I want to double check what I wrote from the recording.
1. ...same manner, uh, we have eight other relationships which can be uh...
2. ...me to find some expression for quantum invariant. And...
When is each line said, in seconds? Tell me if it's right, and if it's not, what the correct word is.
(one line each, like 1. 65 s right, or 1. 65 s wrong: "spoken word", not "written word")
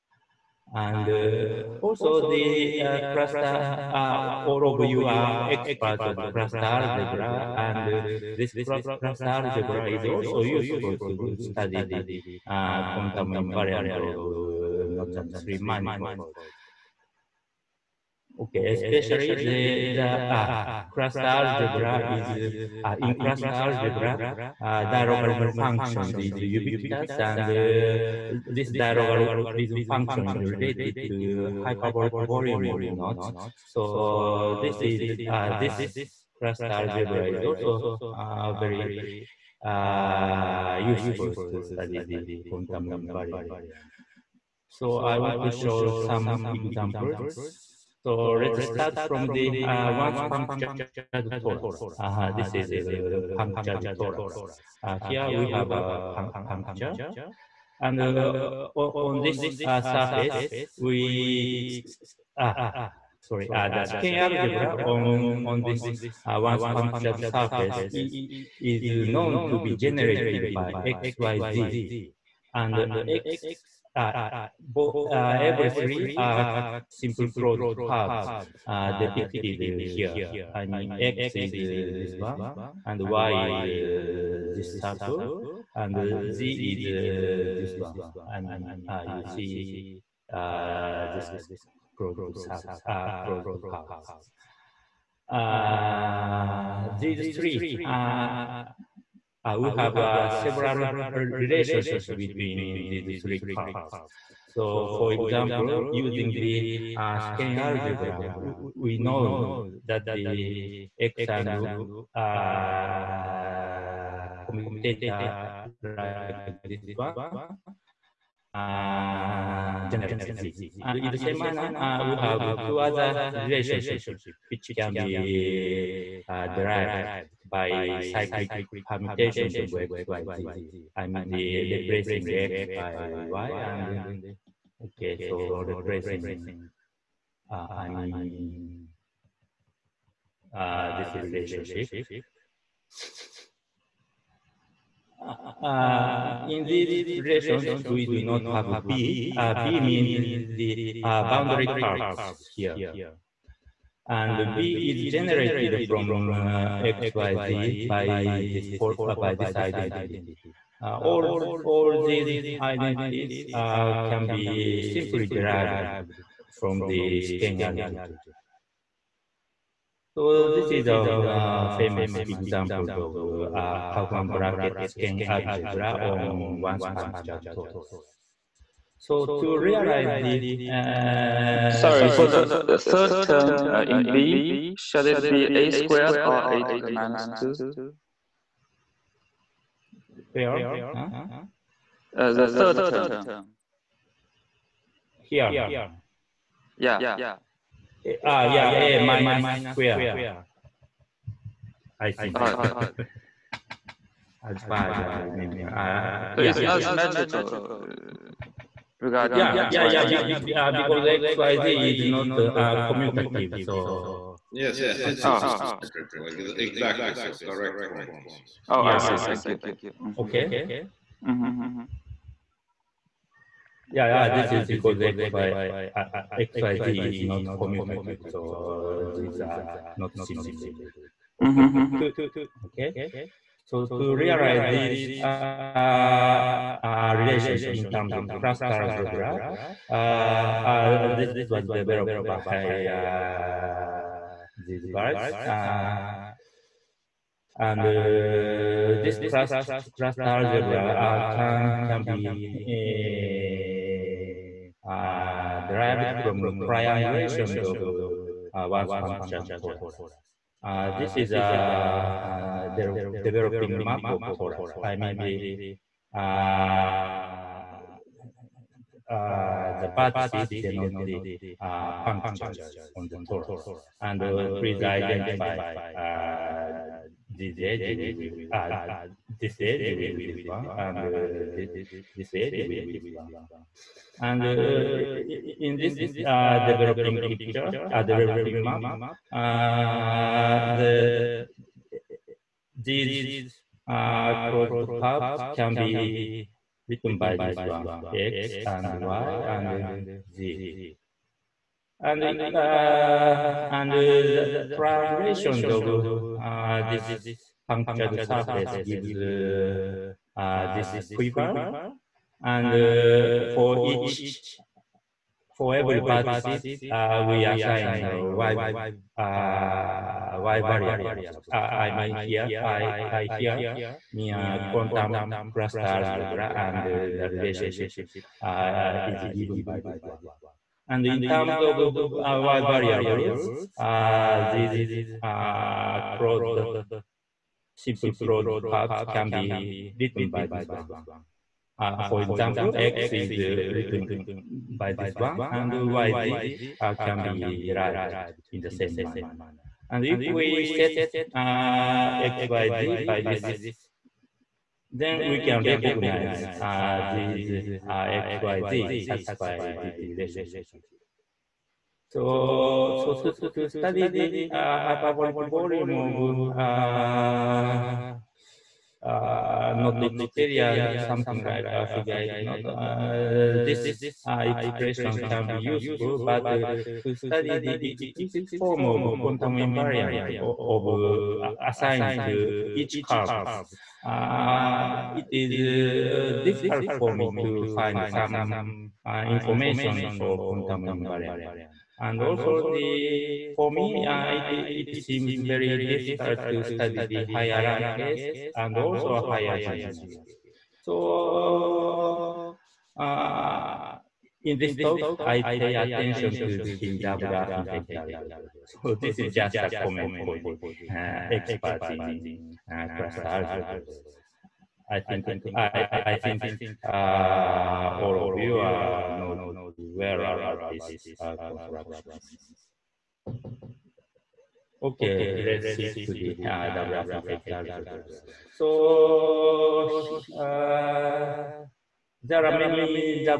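1. 121 s wrong: "two", not "eight"
2. 387 s wrong: "information", not "expression".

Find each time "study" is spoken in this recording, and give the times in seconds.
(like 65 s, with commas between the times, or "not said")
11 s, 41 s, 363 s, 377 s, 396 s.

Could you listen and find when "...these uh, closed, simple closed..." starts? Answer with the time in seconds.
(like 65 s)
334 s.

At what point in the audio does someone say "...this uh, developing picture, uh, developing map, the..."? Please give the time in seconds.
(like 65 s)
285 s.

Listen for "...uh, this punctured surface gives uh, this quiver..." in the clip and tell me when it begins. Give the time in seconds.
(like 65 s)
306 s.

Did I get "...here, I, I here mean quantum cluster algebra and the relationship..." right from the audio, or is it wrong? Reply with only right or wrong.
right.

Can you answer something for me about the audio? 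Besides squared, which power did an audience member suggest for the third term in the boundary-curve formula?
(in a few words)
a to the minus two.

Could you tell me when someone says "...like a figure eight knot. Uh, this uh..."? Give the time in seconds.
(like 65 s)
371 s.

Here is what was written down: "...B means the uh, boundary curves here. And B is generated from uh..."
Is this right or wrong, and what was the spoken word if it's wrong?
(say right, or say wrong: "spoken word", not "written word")
right.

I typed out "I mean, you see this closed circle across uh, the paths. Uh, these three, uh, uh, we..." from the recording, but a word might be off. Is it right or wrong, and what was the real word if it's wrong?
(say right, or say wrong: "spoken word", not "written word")
right.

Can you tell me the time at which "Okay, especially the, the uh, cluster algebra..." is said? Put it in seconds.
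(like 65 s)
18 s.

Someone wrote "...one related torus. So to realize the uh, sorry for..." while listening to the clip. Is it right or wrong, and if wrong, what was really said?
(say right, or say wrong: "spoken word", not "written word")
wrong: "punctured", not "related".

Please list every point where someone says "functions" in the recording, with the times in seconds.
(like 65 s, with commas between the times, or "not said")
25 s, 29 s.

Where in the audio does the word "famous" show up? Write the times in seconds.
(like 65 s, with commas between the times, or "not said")
171 s.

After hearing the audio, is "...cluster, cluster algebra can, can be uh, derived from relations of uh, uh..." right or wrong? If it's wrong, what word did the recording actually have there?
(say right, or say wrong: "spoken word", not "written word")
wrong: "triangulations", not "relations".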